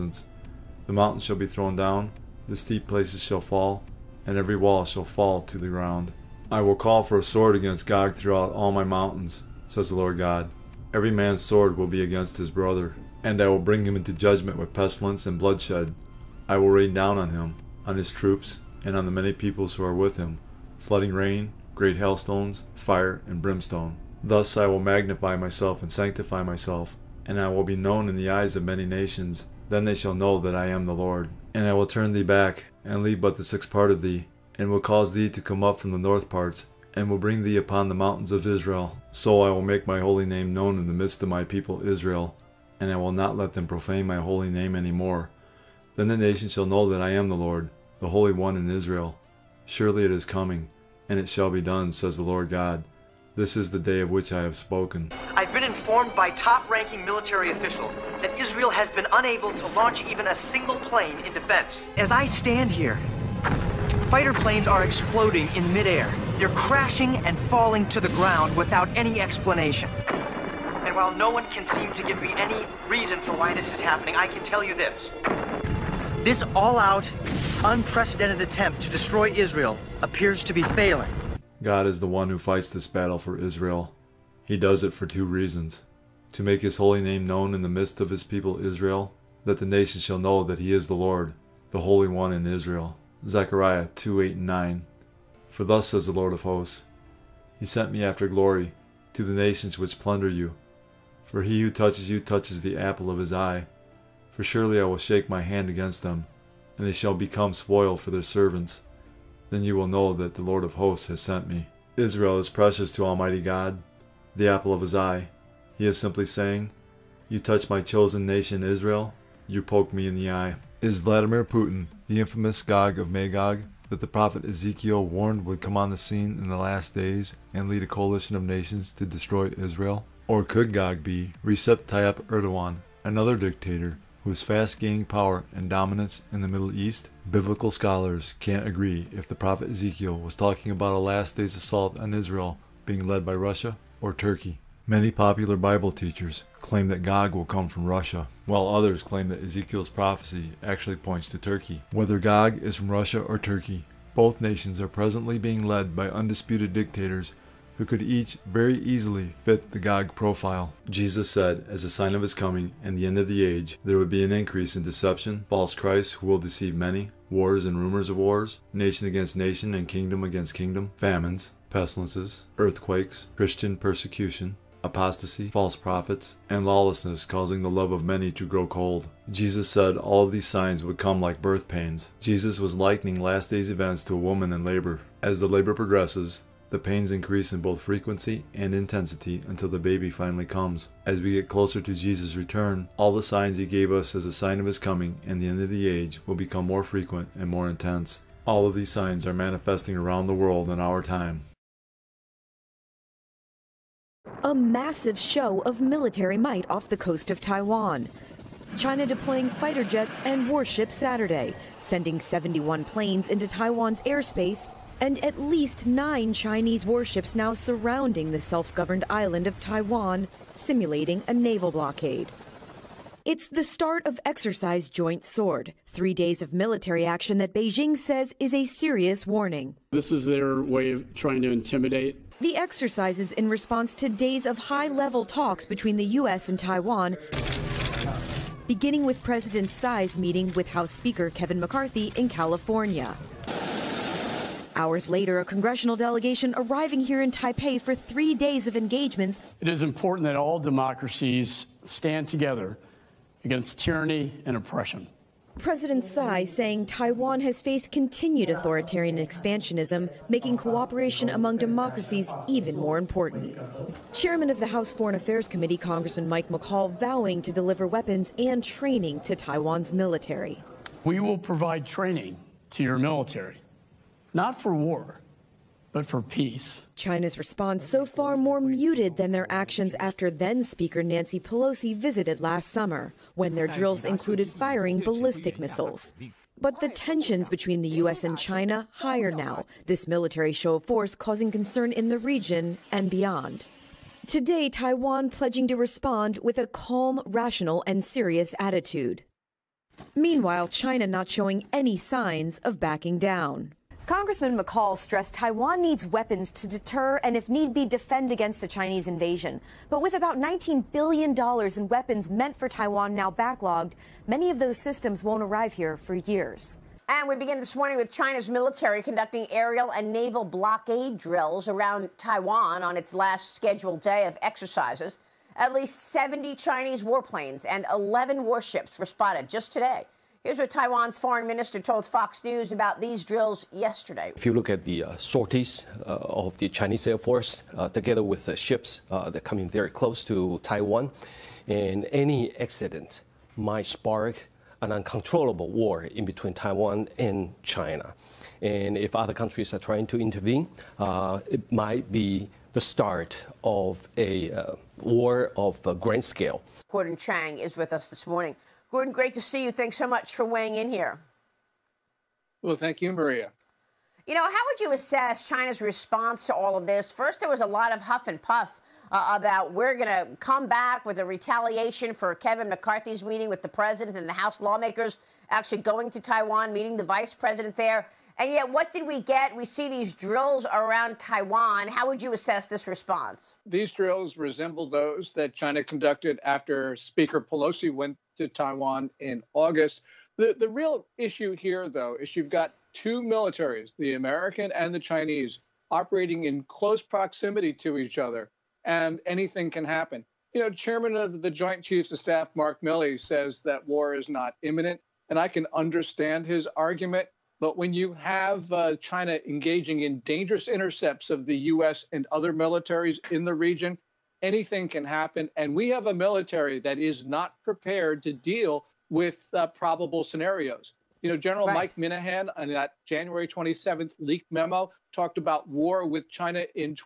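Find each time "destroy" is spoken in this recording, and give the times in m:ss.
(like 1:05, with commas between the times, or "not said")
1:18, 2:09.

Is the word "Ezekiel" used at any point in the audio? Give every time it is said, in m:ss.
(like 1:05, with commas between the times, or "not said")
2:04, 2:19, 2:29.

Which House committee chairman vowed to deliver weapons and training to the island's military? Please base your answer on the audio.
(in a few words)
Mike McCaul.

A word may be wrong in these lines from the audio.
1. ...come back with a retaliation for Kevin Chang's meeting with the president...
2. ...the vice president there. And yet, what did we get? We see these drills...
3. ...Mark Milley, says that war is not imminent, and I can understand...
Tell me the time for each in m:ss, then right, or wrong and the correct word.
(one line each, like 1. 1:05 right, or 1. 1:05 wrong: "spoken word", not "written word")
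1. 6:10 wrong: "McCarthy", not "Chang"
2. 6:16 right
3. 6:42 right.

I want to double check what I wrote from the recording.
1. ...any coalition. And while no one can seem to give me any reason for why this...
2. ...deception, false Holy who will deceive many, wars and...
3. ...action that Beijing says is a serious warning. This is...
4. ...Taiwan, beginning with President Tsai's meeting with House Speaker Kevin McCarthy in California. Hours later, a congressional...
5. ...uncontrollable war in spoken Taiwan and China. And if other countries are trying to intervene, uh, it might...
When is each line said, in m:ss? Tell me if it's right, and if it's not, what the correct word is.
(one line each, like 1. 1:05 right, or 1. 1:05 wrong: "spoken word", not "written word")
1. 1:08 wrong: "explanation", not "coalition"
2. 2:44 wrong: "Christ", not "Holy"
3. 3:47 right
4. 3:56 right
5. 5:44 wrong: "between", not "spoken".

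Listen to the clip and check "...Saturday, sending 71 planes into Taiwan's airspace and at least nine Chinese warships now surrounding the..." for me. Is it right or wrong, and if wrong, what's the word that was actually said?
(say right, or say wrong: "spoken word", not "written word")
right.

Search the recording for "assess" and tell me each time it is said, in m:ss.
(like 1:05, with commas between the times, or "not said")
6:04, 6:22.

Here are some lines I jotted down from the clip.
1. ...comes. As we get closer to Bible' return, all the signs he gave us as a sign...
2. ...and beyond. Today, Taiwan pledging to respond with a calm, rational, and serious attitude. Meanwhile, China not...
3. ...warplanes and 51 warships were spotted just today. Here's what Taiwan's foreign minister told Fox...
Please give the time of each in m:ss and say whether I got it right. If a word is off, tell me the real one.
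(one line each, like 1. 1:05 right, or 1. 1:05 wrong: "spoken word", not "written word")
1. 3:10 wrong: "Jesus", not "Bible"
2. 4:52 right
3. 5:27 wrong: "11", not "51".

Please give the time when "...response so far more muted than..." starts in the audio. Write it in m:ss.
4:37.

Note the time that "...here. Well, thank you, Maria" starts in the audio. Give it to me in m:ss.
6:00.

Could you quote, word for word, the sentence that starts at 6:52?
and other militaries in the region, anything can happen.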